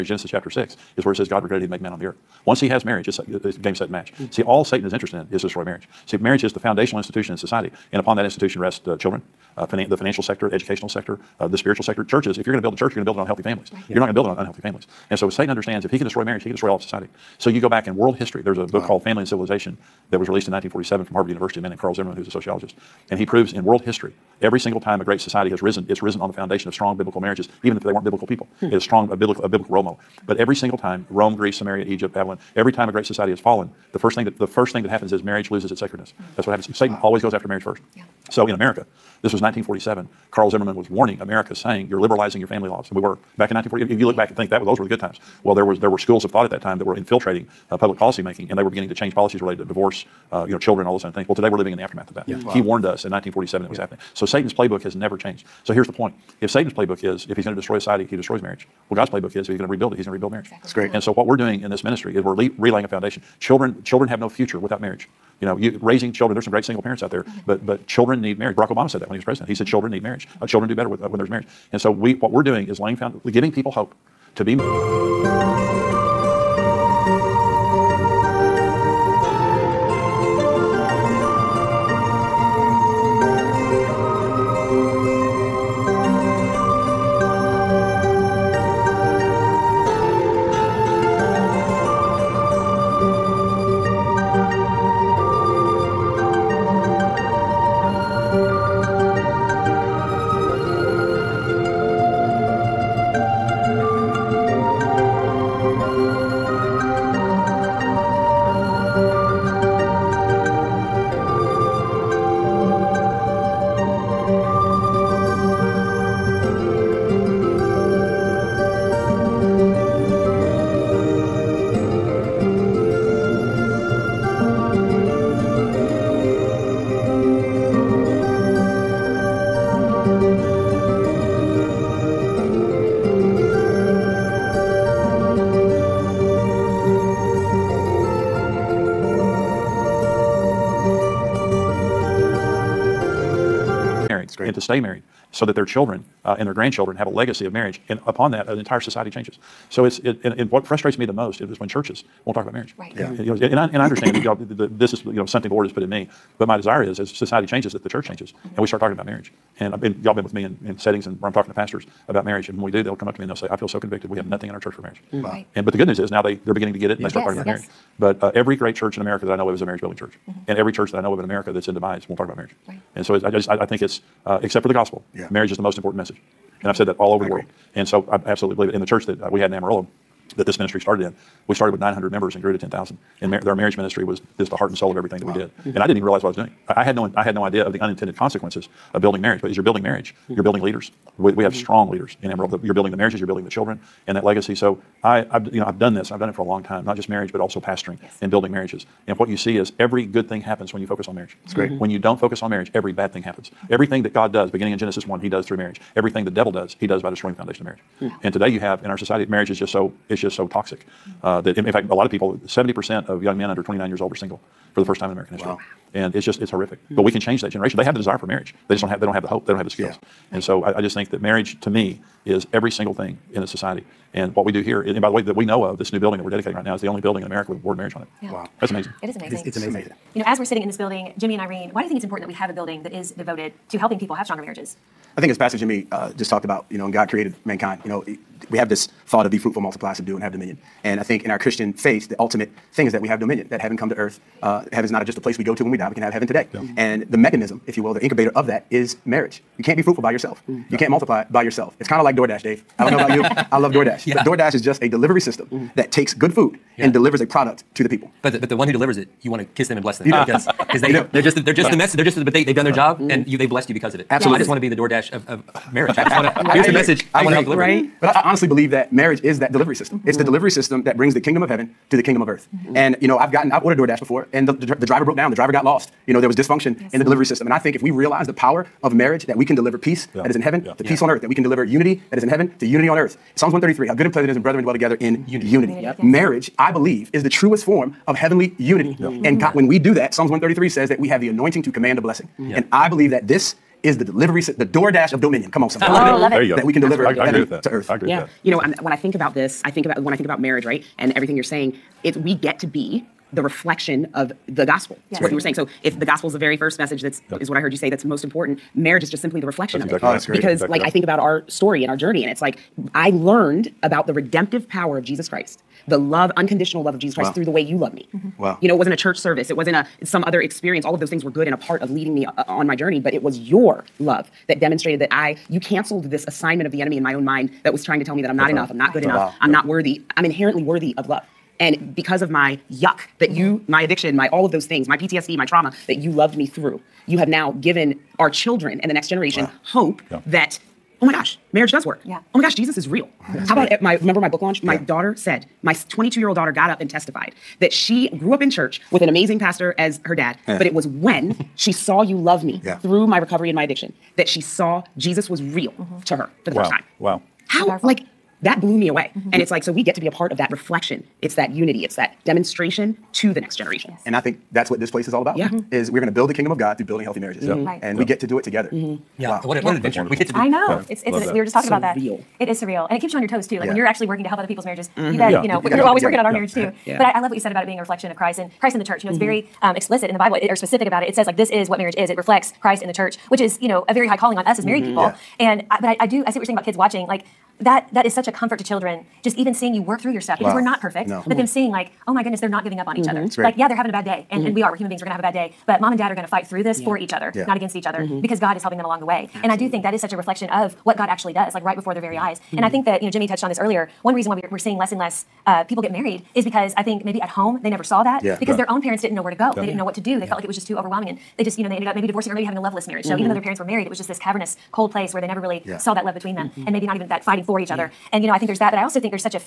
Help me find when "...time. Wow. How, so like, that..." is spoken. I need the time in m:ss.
5:56.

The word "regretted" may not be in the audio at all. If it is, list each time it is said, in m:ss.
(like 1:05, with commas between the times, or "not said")
0:01.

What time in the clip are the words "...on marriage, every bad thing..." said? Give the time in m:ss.
3:22.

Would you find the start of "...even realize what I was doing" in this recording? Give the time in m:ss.
3:05.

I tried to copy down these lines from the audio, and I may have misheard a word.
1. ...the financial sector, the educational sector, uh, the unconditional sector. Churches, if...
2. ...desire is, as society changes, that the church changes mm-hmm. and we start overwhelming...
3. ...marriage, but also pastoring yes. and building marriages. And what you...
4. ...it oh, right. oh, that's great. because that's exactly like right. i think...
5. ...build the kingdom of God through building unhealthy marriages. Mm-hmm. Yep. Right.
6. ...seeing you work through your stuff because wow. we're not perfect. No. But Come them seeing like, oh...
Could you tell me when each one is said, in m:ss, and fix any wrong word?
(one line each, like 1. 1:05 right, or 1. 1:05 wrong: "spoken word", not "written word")
1. 0:09 wrong: "spiritual", not "unconditional"
2. 2:36 wrong: "talking", not "overwhelming"
3. 3:17 right
4. 5:10 right
5. 6:06 wrong: "healthy", not "unhealthy"
6. 6:29 right.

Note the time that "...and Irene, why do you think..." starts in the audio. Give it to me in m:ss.
3:51.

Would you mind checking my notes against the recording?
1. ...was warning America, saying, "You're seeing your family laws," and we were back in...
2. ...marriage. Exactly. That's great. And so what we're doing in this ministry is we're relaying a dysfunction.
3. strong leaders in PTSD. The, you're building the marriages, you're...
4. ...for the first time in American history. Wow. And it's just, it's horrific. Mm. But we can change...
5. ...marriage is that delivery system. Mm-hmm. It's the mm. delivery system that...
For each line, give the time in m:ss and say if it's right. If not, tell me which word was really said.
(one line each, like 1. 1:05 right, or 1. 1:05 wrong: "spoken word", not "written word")
1. 0:40 wrong: "liberalizing", not "seeing"
2. 1:00 wrong: "foundation", not "dysfunction"
3. 3:11 wrong: "Amarillo", not "PTSD"
4. 3:34 right
5. 4:28 right.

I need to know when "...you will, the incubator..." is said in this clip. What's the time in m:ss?
4:07.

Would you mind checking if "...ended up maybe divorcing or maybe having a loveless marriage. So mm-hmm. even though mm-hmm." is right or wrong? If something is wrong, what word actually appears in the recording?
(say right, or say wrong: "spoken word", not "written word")
right.